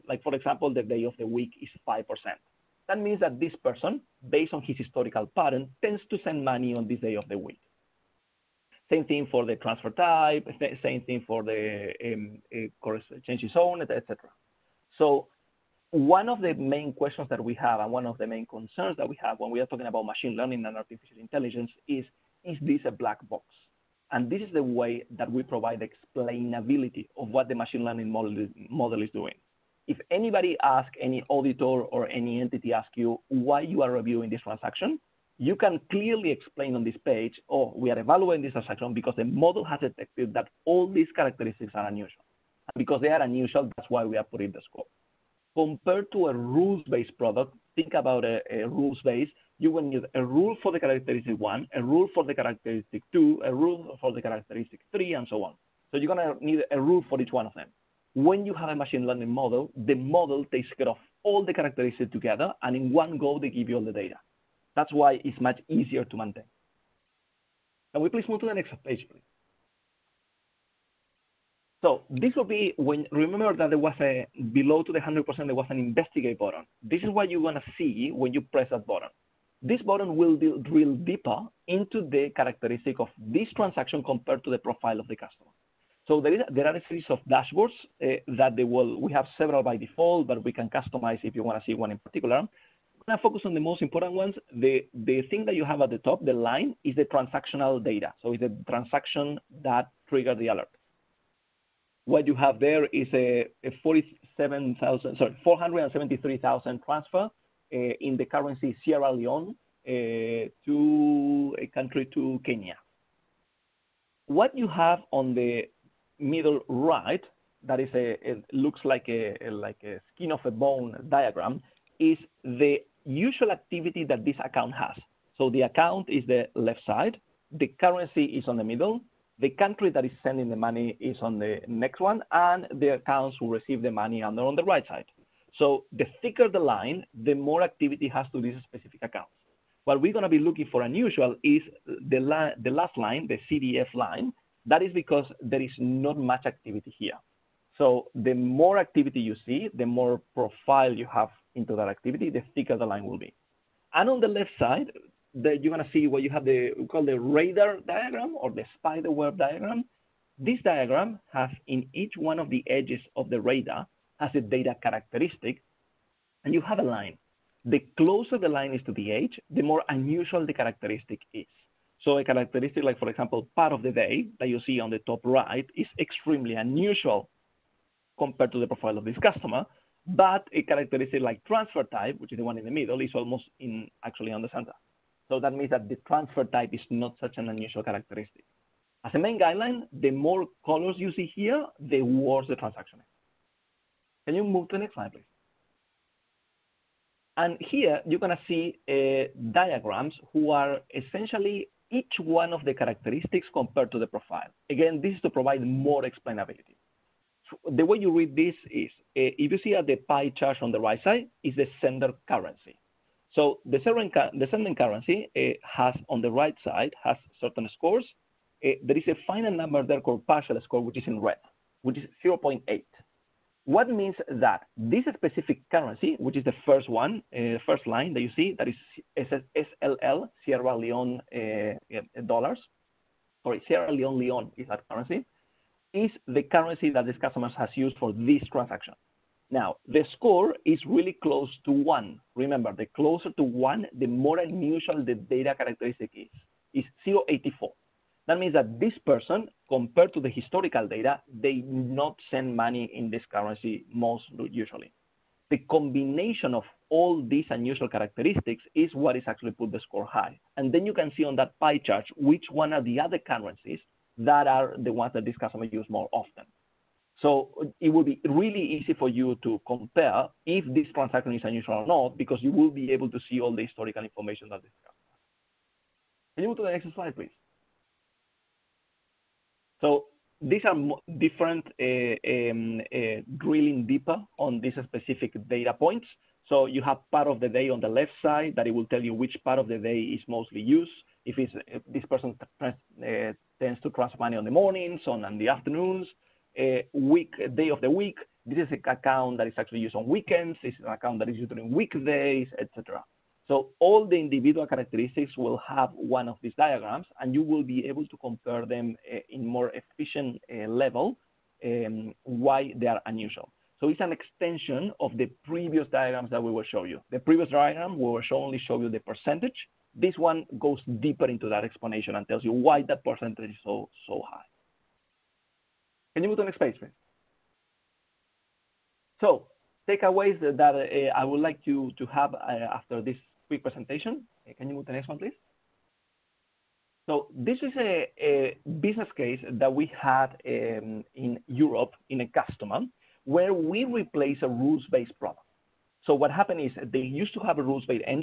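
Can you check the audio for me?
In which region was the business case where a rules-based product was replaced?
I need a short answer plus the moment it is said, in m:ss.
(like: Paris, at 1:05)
Europe, at 5:41.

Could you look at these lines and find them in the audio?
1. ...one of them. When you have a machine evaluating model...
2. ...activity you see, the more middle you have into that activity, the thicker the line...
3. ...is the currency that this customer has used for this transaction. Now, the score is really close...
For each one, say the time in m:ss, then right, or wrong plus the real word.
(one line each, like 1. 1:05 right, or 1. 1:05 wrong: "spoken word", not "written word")
1. 0:57 wrong: "learning", not "evaluating"
2. 2:28 wrong: "profile", not "middle"
3. 3:56 right.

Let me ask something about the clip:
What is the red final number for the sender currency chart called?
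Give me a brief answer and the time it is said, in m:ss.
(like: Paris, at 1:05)
partial score, at 3:40.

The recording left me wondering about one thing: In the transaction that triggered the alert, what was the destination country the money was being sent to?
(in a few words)
Kenya.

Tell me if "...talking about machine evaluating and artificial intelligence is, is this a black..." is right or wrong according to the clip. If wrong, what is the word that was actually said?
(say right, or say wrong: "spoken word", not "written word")
wrong: "learning", not "evaluating".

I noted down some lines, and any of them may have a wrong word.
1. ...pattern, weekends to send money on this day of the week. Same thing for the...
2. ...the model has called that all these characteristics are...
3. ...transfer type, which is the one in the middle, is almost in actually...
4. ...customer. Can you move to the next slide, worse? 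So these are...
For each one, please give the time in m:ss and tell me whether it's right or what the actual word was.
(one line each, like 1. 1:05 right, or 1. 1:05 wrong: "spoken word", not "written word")
1. 0:05 wrong: "tends", not "weekends"
2. 0:39 wrong: "detected", not "called"
3. 3:01 right
4. 4:34 wrong: "please", not "worse".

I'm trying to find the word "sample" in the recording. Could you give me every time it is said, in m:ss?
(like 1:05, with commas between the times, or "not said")
not said.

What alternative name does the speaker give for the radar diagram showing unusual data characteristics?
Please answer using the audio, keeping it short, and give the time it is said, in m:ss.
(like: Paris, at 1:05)
spider web diagram, at 2:38.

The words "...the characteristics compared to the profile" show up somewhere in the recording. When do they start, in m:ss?
3:22.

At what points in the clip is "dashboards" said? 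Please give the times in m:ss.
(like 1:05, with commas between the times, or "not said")
1:27.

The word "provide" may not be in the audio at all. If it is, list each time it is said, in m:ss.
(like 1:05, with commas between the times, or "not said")
0:25, 3:25.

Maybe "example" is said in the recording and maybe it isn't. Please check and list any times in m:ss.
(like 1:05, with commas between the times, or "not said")
0:00, 2:53.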